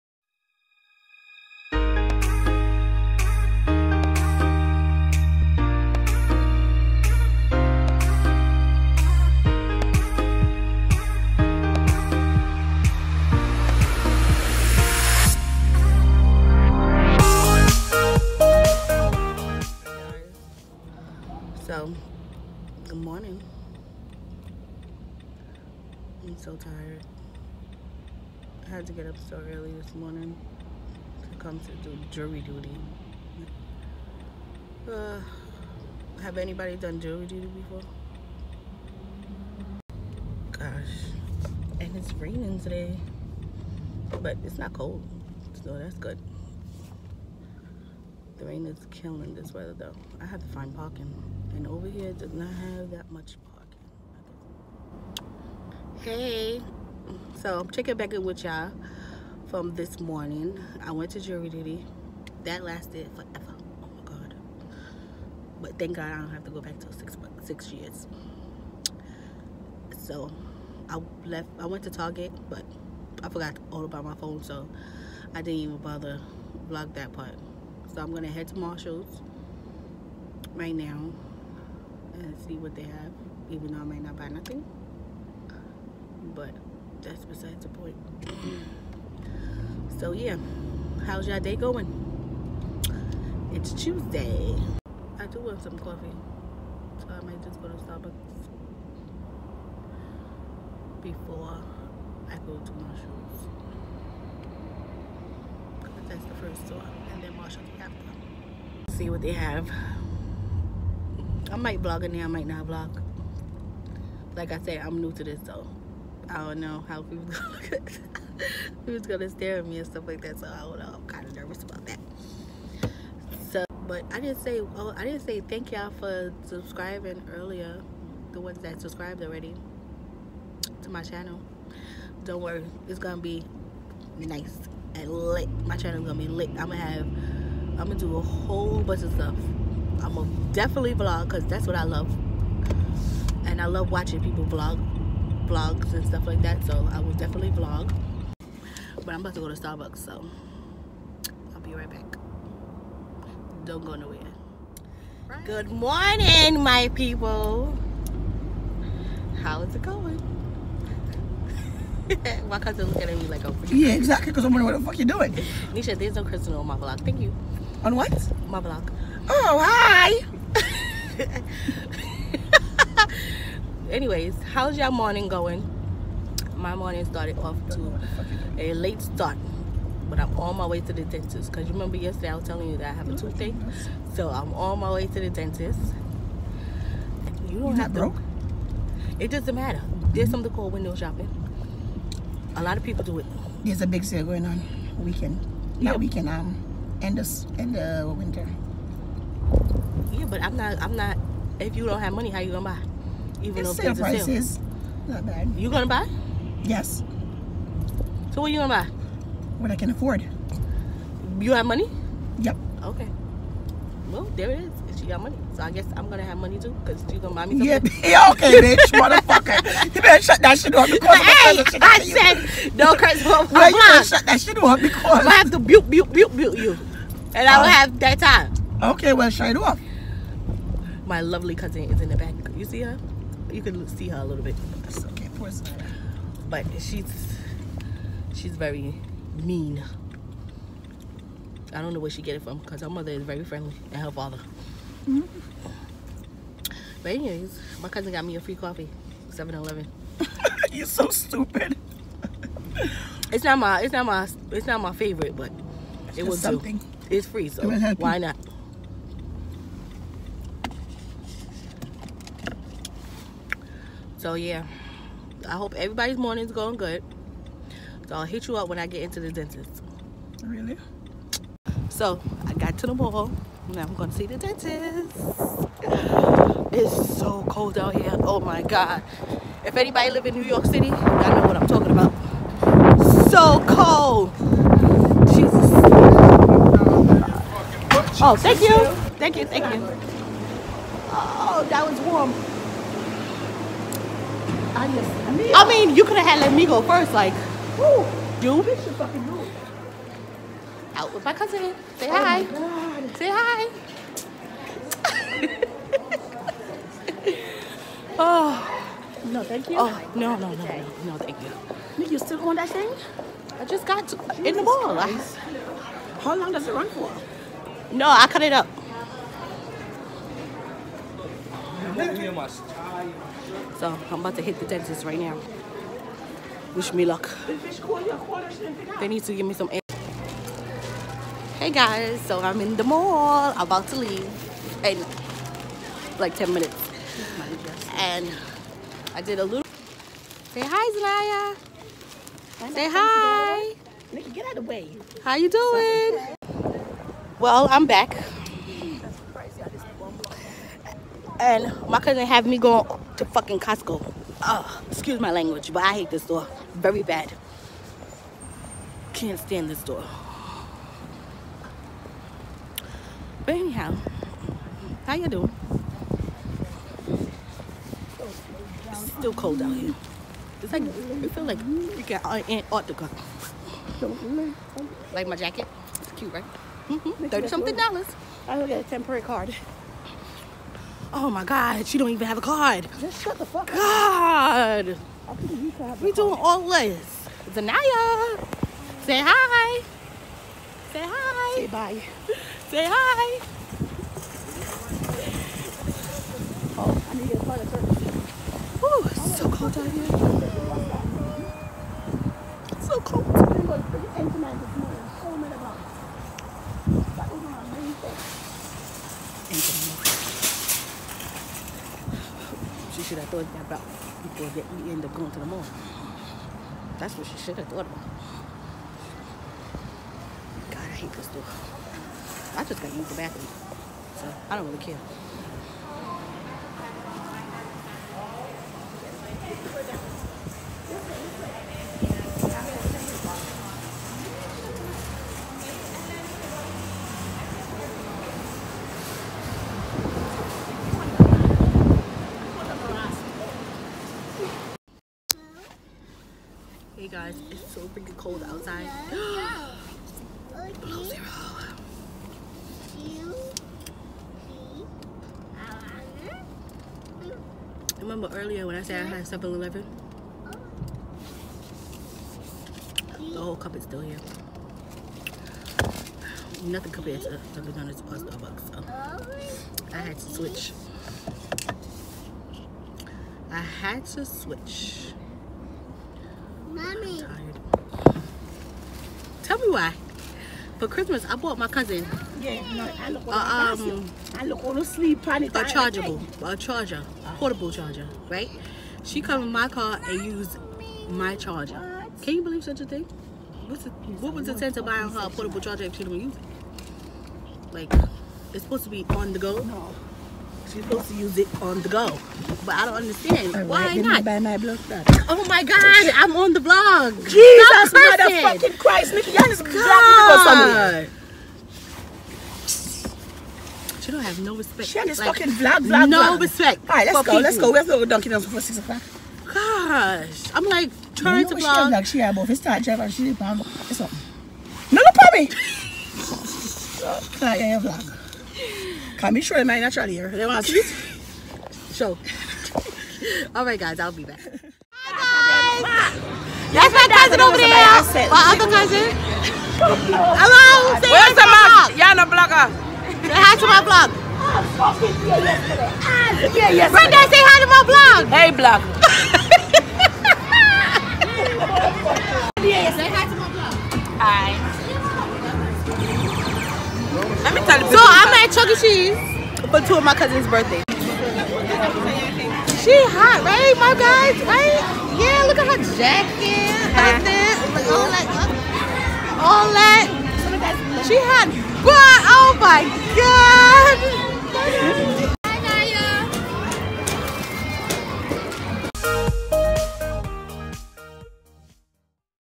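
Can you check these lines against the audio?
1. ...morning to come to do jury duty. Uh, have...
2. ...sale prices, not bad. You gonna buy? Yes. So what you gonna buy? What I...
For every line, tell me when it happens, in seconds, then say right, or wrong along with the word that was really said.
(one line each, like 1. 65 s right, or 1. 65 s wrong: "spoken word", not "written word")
1. 29 s right
2. 203 s right.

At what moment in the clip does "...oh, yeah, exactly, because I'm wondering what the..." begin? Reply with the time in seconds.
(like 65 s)
163 s.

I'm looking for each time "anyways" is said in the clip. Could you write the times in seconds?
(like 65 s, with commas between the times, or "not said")
173 s, 247 s.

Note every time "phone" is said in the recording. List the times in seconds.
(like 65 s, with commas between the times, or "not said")
74 s.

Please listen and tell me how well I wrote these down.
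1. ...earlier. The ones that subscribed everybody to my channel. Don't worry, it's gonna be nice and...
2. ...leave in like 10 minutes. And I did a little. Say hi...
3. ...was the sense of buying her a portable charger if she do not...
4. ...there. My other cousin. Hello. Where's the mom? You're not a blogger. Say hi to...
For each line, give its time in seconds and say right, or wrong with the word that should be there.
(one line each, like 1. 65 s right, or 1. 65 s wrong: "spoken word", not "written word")
1. 127 s wrong: "already", not "everybody"
2. 333 s right
3. 494 s right
4. 537 s right.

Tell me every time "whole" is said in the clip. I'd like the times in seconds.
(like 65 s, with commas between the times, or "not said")
138 s, 463 s.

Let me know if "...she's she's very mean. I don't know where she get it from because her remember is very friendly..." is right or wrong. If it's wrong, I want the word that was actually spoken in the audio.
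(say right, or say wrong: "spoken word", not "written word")
wrong: "mother", not "remember".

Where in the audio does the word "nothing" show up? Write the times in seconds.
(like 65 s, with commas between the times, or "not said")
84 s, 466 s.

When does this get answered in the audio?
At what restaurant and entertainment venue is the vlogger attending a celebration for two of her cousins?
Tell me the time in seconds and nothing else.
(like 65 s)
558 s.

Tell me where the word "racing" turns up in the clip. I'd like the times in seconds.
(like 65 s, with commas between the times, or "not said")
not said.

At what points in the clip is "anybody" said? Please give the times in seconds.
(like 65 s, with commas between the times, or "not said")
36 s, 279 s.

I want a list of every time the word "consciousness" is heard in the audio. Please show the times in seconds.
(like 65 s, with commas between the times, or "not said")
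not said.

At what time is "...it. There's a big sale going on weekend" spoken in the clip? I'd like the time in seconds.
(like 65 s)
193 s.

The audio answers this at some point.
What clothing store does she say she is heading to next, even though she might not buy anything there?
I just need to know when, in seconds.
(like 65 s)
78 s.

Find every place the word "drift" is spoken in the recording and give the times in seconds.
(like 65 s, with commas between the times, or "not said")
not said.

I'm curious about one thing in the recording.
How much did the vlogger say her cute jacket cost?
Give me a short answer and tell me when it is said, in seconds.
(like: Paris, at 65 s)
30 something dollars, at 377 s.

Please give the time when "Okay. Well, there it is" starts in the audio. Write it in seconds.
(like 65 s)
212 s.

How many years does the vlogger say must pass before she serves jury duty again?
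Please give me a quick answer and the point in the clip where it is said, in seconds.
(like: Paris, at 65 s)
6, at 67 s.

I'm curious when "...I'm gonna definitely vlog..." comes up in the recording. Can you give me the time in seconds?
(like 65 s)
139 s.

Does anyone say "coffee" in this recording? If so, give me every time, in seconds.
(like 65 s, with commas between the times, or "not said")
95 s, 248 s.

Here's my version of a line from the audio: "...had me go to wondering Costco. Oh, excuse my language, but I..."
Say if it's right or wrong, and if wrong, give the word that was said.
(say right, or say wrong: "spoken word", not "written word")
wrong: "fucking", not "wondering".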